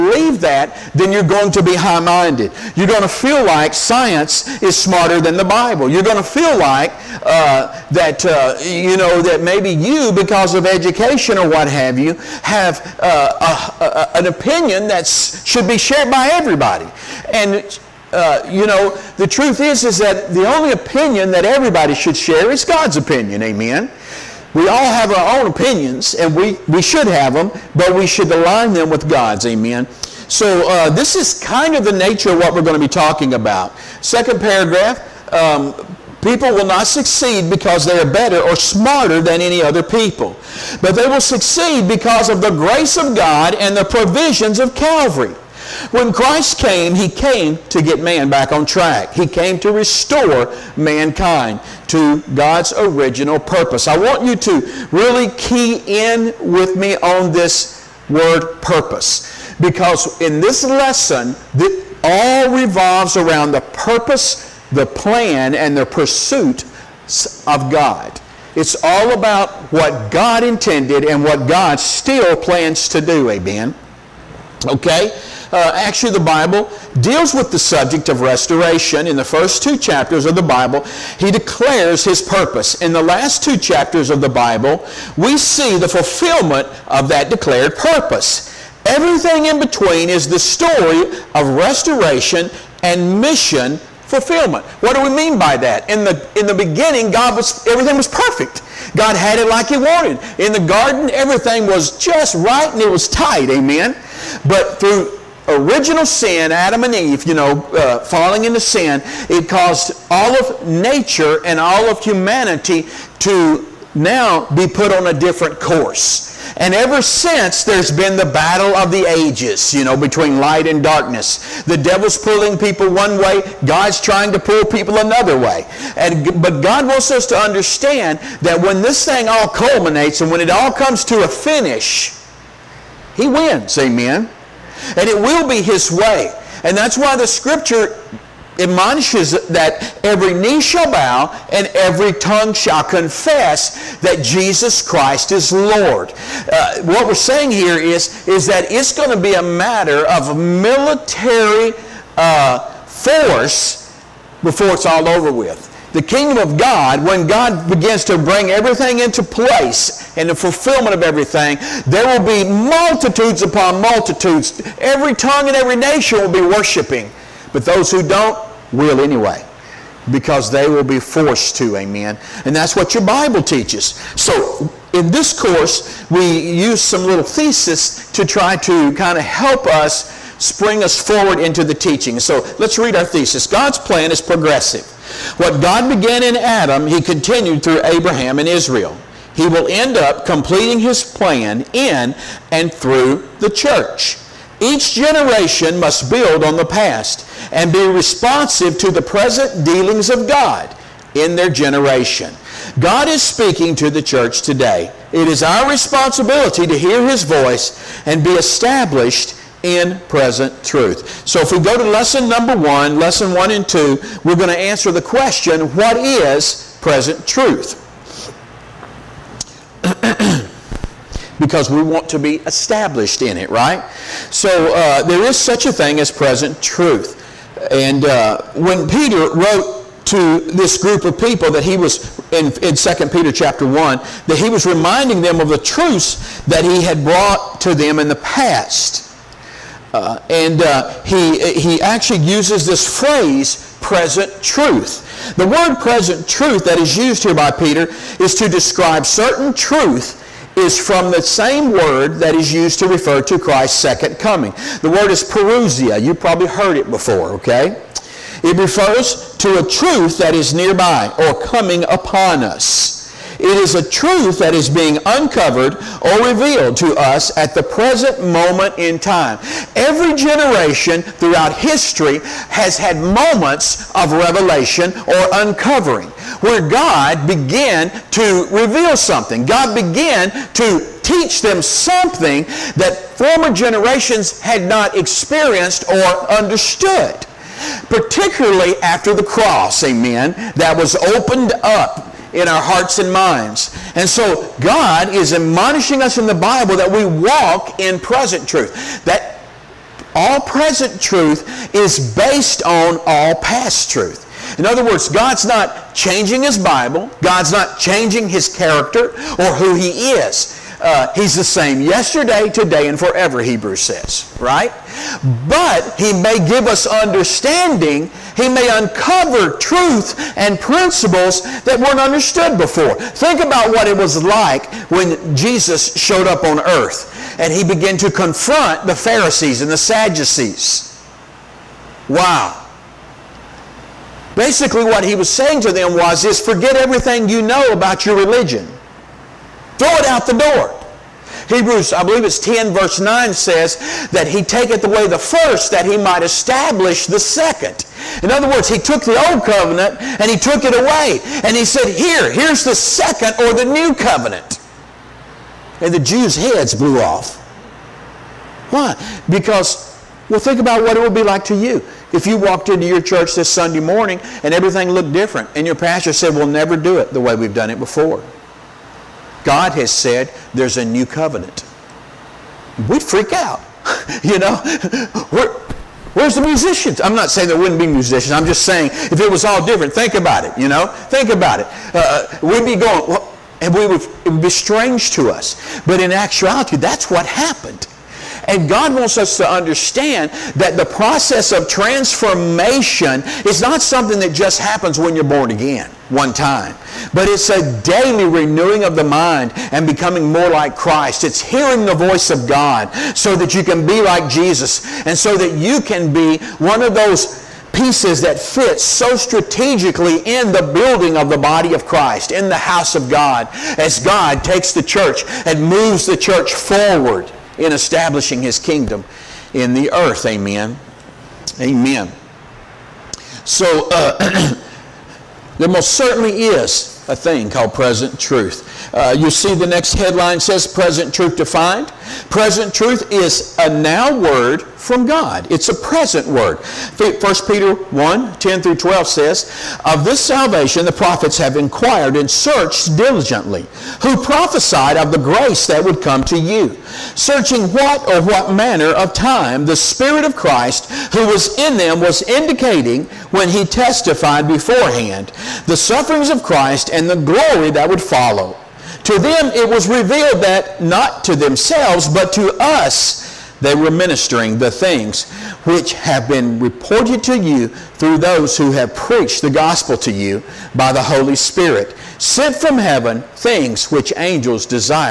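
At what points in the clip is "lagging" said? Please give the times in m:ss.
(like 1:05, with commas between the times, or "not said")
not said.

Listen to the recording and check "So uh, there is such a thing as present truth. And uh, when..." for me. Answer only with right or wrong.
right.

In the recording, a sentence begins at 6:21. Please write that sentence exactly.
Uh, uh we'd be going, well, and we would, it would be strange to us.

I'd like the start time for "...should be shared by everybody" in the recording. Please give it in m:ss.
0:15.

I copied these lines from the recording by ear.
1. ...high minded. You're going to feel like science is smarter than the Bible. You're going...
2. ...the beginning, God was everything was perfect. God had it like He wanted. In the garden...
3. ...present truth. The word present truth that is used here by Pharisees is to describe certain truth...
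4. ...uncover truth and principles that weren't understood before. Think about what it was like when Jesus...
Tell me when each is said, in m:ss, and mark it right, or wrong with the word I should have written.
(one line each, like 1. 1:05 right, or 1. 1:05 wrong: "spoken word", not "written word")
1. 0:01 right
2. 1:36 right
3. 4:03 wrong: "Peter", not "Pharisees"
4. 5:18 right.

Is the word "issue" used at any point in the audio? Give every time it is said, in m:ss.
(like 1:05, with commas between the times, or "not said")
not said.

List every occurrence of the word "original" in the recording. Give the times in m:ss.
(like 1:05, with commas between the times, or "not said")
0:52, 1:45.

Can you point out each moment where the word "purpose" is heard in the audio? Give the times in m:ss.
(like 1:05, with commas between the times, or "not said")
0:53, 0:58, 1:03, 1:22, 1:27.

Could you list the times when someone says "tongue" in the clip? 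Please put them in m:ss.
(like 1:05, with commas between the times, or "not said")
2:22, 2:45.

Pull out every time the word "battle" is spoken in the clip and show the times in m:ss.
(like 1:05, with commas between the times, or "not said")
1:58.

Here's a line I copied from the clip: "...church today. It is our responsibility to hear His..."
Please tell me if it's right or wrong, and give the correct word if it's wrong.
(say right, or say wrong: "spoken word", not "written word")
right.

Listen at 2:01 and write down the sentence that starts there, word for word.
The devil's pulling people one way, God's trying to pull people another way.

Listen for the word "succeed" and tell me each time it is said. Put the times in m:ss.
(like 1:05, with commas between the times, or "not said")
0:36, 0:41.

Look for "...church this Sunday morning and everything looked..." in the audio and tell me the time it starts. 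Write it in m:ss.
6:03.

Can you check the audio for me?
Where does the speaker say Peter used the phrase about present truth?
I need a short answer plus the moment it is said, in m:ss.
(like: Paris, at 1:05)
2 Peter 1, at 3:52.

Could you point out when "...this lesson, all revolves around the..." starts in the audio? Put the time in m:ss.
1:00.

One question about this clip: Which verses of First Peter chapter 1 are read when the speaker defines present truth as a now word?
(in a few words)
10 through 12.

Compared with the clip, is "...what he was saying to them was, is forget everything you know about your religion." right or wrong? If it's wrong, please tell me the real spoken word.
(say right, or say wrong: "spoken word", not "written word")
right.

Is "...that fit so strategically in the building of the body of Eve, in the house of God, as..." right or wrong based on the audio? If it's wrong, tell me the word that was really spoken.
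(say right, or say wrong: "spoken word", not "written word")
wrong: "Christ", not "Eve".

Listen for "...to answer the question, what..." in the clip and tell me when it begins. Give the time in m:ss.
3:34.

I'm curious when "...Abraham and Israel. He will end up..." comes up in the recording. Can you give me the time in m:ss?
3:07.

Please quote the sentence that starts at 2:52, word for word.
And that's what your Bible teaches.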